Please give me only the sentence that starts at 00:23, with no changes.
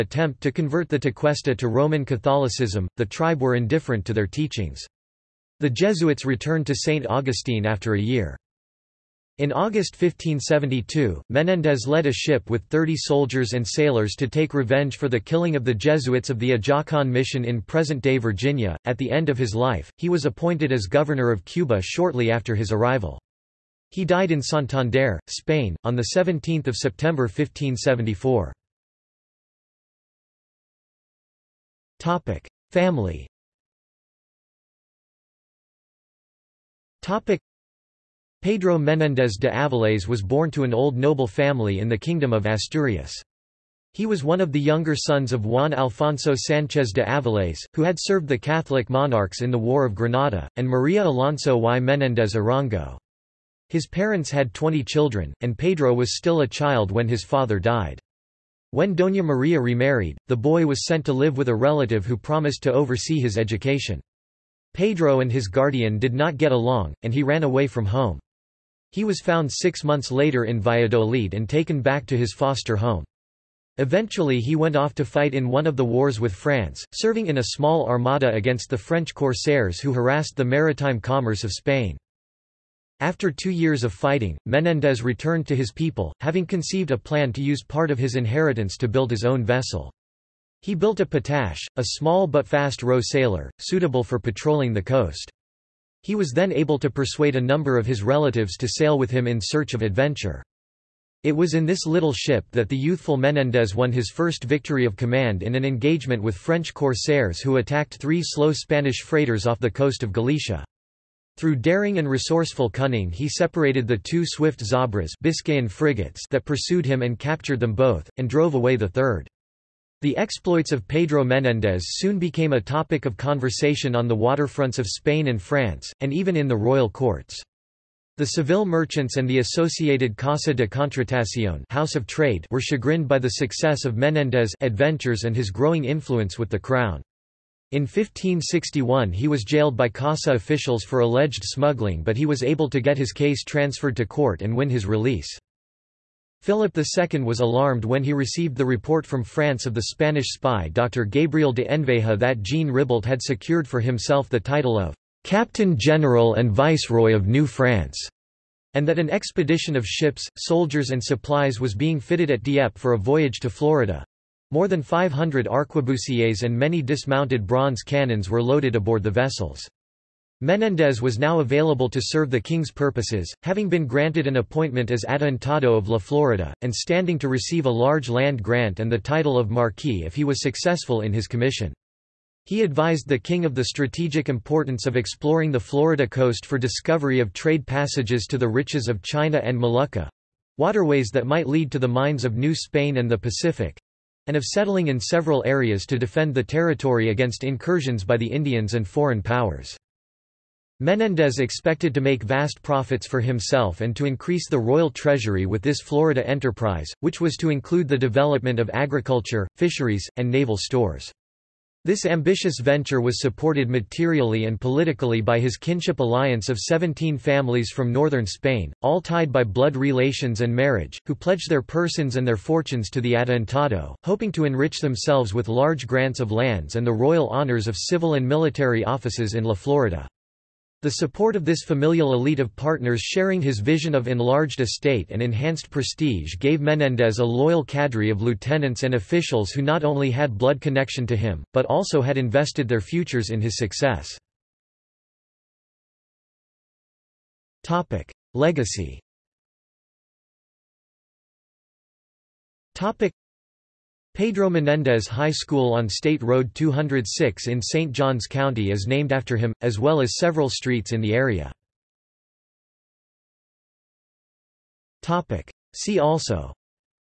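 He died in Santander, Spain, on 17 September 1574.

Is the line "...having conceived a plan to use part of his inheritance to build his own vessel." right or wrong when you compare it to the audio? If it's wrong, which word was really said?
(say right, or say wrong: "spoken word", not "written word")
right.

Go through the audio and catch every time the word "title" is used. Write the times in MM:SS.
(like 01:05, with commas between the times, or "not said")
02:34, 02:58.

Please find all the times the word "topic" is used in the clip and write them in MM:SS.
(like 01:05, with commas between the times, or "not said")
00:37, 02:02.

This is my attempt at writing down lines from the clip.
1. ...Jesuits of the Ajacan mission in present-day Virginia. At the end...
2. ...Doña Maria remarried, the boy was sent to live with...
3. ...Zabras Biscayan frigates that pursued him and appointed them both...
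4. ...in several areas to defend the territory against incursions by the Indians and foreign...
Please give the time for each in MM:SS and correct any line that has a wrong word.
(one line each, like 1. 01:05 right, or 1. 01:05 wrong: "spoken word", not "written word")
1. 00:15 right
2. 00:58 right
3. 01:54 wrong: "captured", not "appointed"
4. 03:14 right.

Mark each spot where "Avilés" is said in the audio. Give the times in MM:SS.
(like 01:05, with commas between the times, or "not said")
00:39, 00:47.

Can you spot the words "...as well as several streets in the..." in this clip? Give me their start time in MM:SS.
04:19.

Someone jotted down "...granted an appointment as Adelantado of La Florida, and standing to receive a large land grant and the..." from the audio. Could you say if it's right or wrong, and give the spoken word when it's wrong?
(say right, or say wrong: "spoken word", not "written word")
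right.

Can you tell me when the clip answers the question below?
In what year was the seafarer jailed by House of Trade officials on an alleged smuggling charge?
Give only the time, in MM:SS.
02:17.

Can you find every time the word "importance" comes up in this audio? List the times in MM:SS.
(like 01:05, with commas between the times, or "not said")
03:04.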